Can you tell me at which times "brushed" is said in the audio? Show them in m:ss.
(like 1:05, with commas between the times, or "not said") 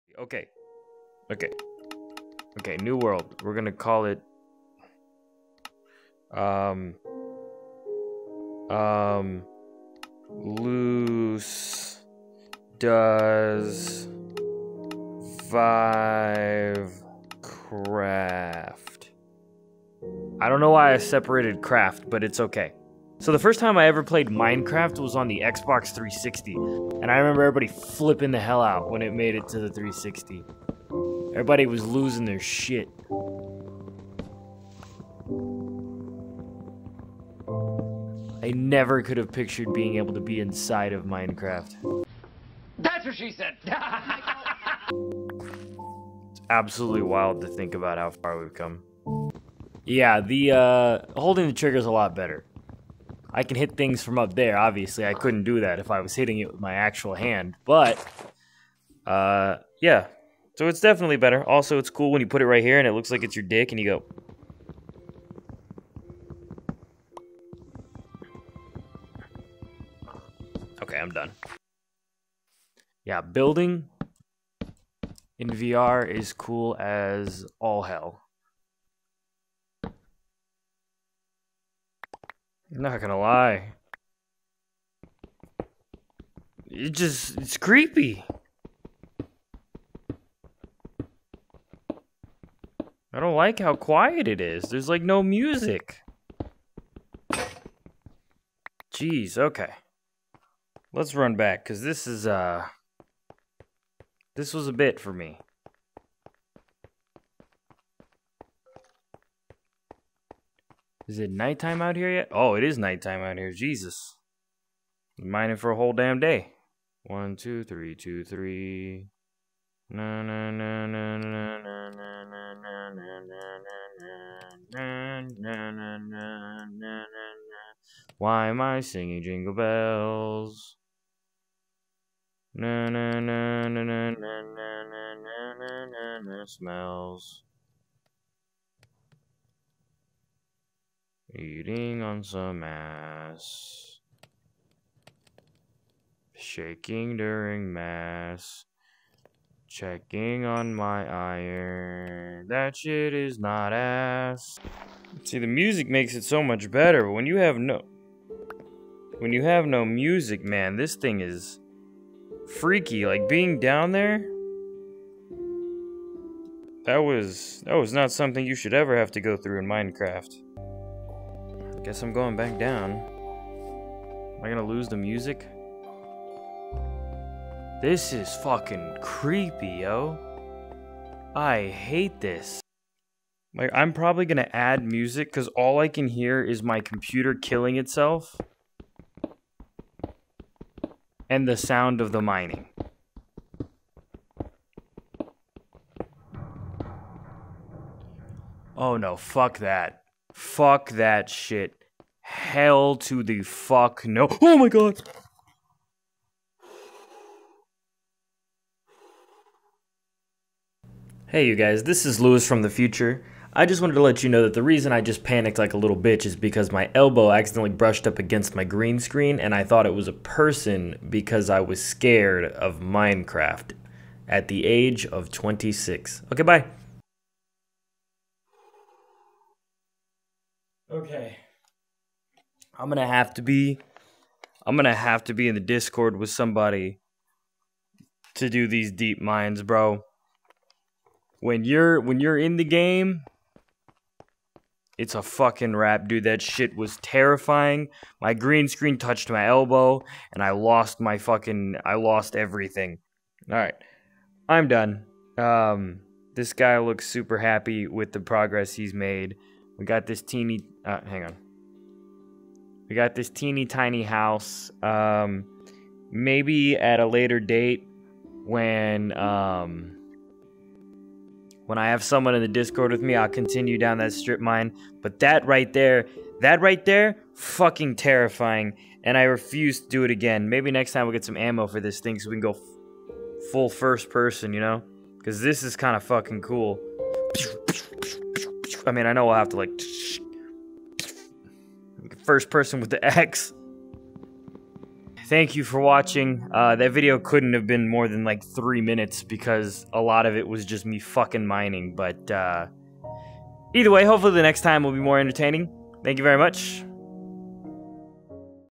3:37.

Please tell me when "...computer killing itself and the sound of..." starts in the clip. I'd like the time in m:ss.
3:06.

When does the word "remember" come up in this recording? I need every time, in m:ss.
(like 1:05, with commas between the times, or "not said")
0:27.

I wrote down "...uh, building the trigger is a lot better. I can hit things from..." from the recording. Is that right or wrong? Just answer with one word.
wrong.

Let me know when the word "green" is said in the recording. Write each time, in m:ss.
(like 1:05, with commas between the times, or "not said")
3:38, 4:08.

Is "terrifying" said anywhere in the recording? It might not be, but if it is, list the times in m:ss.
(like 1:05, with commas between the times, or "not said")
4:06, 4:37.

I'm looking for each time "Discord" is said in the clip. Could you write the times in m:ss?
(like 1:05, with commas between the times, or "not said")
3:55, 4:32.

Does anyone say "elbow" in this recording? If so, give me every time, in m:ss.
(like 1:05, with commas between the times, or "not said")
3:36, 4:09.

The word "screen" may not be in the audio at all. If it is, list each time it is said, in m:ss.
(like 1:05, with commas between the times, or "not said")
3:38, 4:08.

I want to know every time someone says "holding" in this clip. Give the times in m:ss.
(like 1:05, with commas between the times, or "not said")
0:51.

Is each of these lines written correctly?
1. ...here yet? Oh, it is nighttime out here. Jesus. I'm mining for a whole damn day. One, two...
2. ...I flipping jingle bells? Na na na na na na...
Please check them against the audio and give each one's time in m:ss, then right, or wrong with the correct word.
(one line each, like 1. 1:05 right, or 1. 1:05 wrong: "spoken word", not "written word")
1. 1:51 right
2. 2:08 wrong: "singing", not "flipping".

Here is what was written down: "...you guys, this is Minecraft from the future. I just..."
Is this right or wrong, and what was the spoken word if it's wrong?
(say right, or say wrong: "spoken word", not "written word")
wrong: "Luis", not "Minecraft".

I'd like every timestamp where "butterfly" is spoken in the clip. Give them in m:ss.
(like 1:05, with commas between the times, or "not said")
not said.